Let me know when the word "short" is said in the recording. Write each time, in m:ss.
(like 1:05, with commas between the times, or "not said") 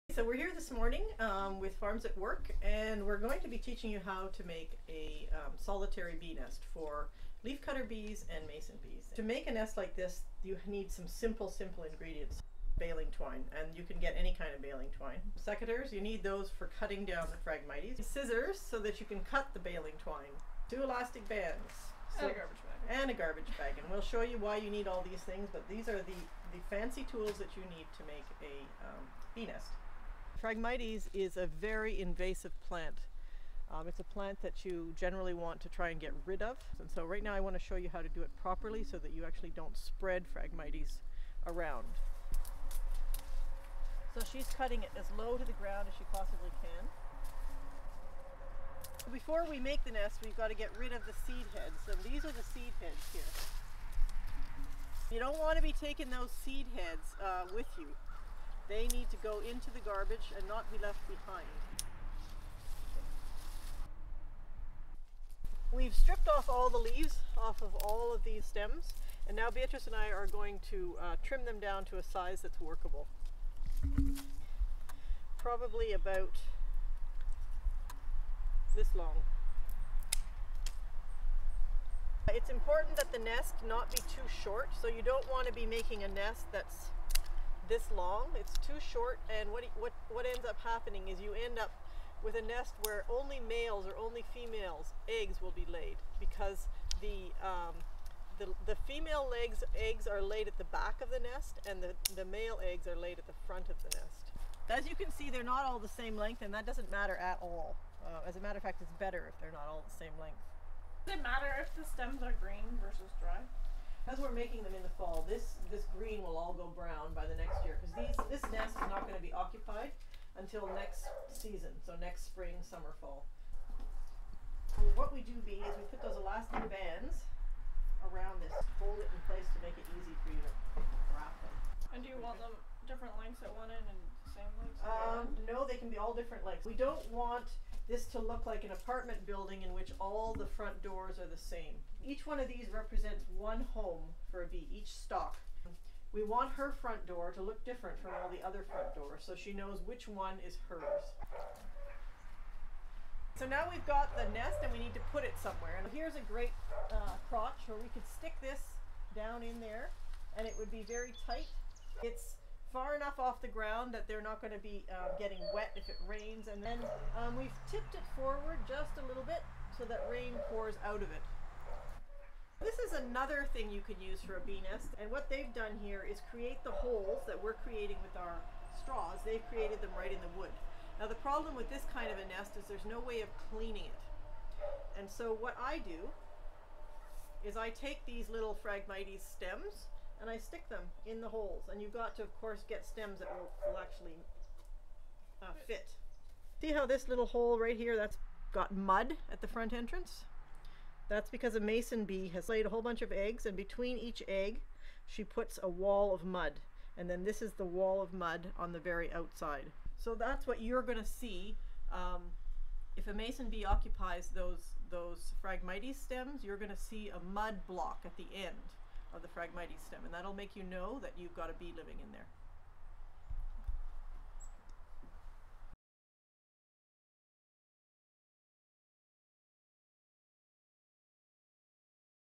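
1:24, 1:28.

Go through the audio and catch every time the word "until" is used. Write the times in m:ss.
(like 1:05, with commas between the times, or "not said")
2:00.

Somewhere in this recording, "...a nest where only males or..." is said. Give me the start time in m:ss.
1:32.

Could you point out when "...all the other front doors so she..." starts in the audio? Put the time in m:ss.
2:28.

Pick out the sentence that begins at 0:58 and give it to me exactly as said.
They need to go into the garbage and not be left behind.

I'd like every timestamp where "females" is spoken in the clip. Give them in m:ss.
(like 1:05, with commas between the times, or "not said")
1:34, 1:38.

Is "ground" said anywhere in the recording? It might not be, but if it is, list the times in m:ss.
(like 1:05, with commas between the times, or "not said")
0:45, 2:43.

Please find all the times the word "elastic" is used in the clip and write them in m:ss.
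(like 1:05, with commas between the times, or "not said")
0:20, 2:06.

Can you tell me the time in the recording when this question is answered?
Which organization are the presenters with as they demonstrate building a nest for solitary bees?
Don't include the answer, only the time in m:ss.
0:01.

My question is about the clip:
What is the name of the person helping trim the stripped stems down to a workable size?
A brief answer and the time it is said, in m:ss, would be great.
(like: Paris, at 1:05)
Beatrice, at 1:09.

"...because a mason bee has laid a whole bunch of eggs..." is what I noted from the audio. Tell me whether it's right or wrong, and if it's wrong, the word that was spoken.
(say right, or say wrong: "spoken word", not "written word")
right.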